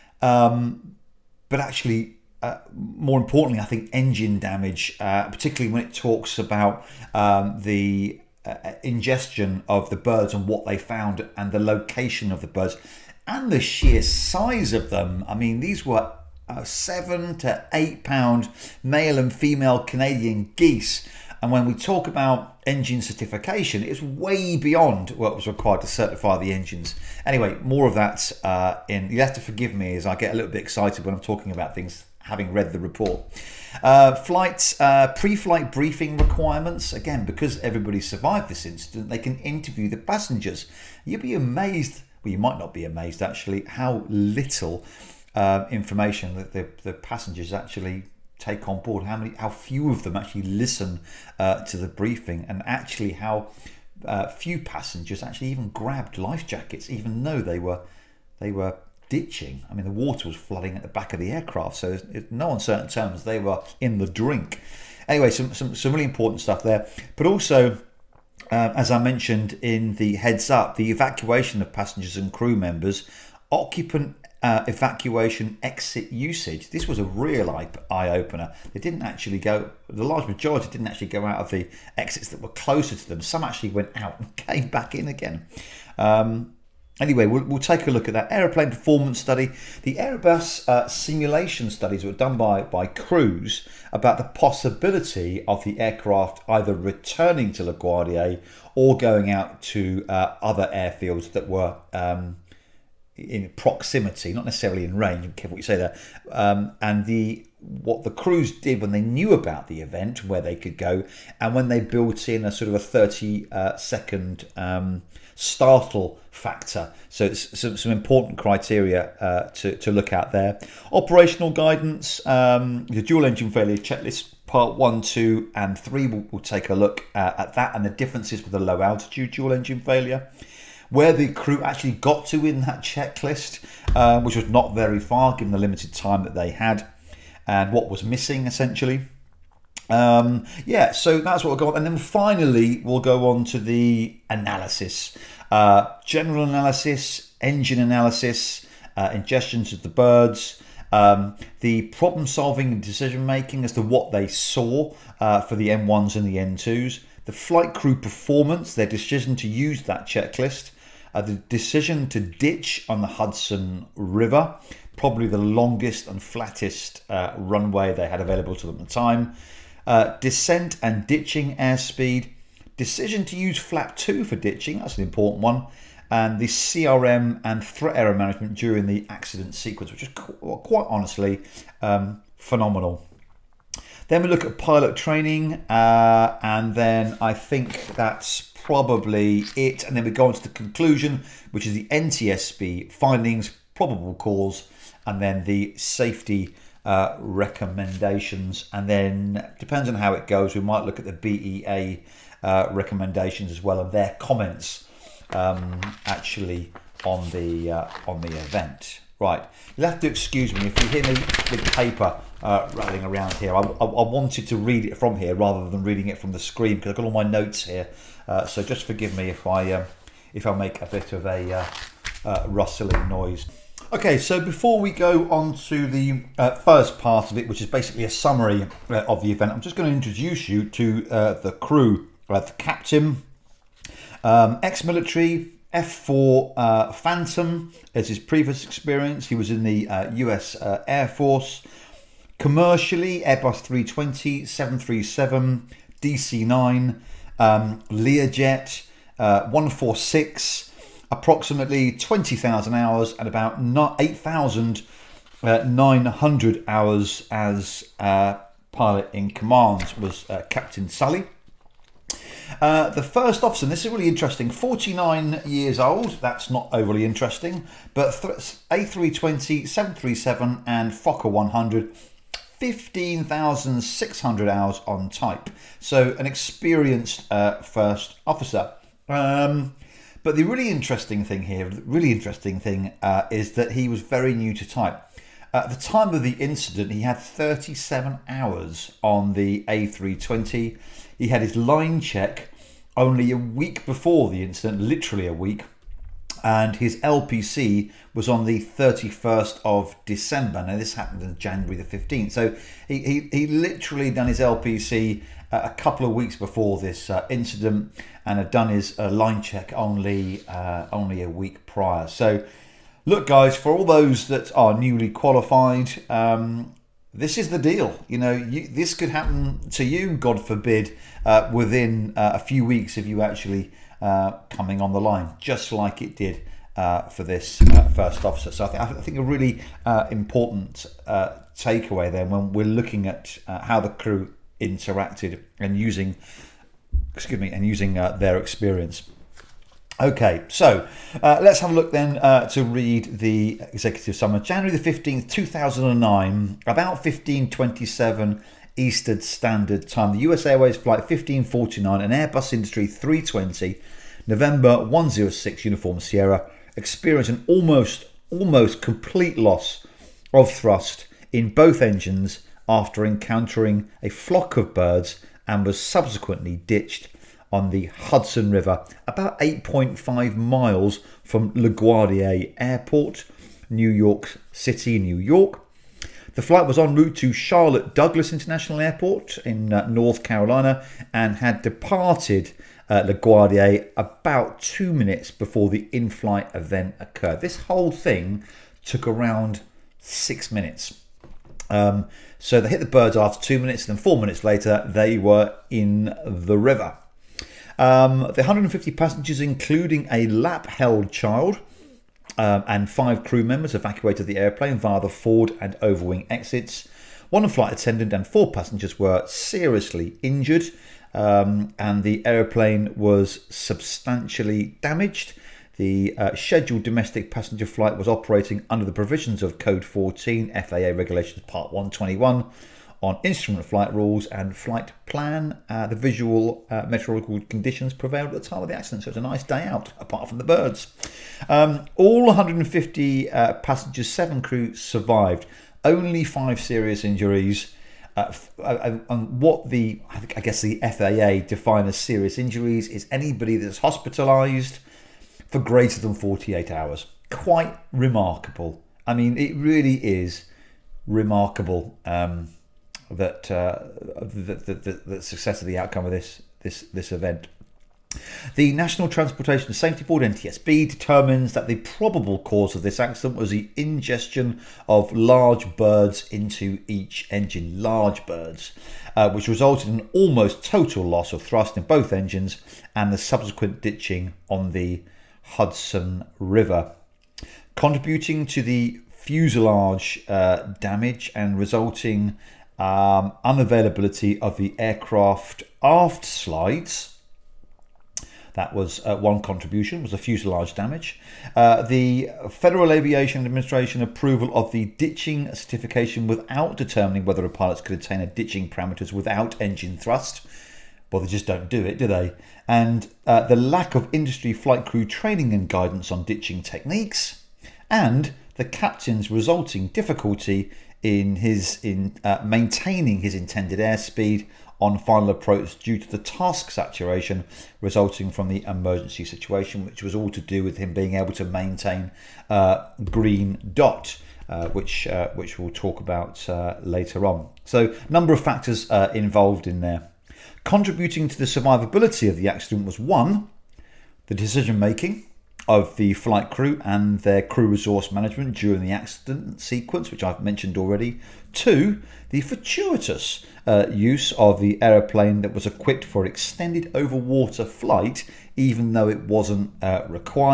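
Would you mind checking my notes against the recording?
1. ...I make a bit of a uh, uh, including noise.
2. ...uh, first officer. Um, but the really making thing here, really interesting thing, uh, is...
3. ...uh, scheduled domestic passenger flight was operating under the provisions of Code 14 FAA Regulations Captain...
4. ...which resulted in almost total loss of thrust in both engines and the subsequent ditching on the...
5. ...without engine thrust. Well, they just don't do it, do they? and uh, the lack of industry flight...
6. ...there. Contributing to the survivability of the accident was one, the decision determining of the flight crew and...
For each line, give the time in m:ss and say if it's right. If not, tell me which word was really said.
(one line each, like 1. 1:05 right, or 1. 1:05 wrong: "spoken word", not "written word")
1. 3:40 wrong: "rustling", not "including"
2. 4:37 wrong: "interesting", not "making"
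3. 6:56 wrong: "Part", not "Captain"
4. 7:49 right
5. 8:19 right
6. 8:49 wrong: "making", not "determining".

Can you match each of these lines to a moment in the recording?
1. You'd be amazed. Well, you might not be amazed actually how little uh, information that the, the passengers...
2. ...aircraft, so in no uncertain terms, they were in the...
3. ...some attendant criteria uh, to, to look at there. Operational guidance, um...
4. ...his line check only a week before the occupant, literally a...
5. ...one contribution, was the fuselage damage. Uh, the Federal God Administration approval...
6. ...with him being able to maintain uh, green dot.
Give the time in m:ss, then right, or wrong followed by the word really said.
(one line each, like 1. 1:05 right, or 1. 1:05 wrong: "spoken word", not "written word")
1. 0:41 right
2. 1:01 right
3. 1:57 wrong: "important", not "attendant"
4. 4:51 wrong: "incident", not "occupant"
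5. 8:09 wrong: "Aviation", not "God"
6. 8:40 right.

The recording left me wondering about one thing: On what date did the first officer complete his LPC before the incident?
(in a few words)
31 December.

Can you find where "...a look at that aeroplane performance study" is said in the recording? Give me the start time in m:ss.
1:27.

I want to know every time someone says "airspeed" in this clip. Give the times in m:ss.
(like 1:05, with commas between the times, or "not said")
2:51, 8:33.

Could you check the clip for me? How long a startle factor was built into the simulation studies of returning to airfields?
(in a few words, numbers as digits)
30 seconds.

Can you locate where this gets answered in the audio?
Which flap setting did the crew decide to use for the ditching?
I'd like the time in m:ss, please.
2:53.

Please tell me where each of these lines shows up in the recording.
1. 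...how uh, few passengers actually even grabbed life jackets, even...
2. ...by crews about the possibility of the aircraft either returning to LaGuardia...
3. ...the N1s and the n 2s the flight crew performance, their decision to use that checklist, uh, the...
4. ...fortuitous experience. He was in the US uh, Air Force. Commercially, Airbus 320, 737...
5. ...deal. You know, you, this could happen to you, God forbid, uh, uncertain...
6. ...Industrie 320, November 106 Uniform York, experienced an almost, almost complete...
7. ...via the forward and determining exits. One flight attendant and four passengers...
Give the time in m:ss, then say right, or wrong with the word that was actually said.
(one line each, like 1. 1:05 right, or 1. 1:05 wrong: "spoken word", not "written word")
1. 0:53 right
2. 1:32 right
3. 2:35 right
4. 3:58 wrong: "previous", not "fortuitous"
5. 5:17 wrong: "within", not "uncertain"
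6. 5:52 wrong: "Sierra", not "York"
7. 6:44 wrong: "overwing", not "determining".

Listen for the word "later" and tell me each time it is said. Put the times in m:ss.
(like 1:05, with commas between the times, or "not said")
6:34, 8:46.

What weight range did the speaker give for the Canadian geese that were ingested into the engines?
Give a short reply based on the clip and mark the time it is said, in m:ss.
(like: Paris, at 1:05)
7 to 8 pounds, at 0:16.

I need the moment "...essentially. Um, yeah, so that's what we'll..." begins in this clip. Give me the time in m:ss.
2:18.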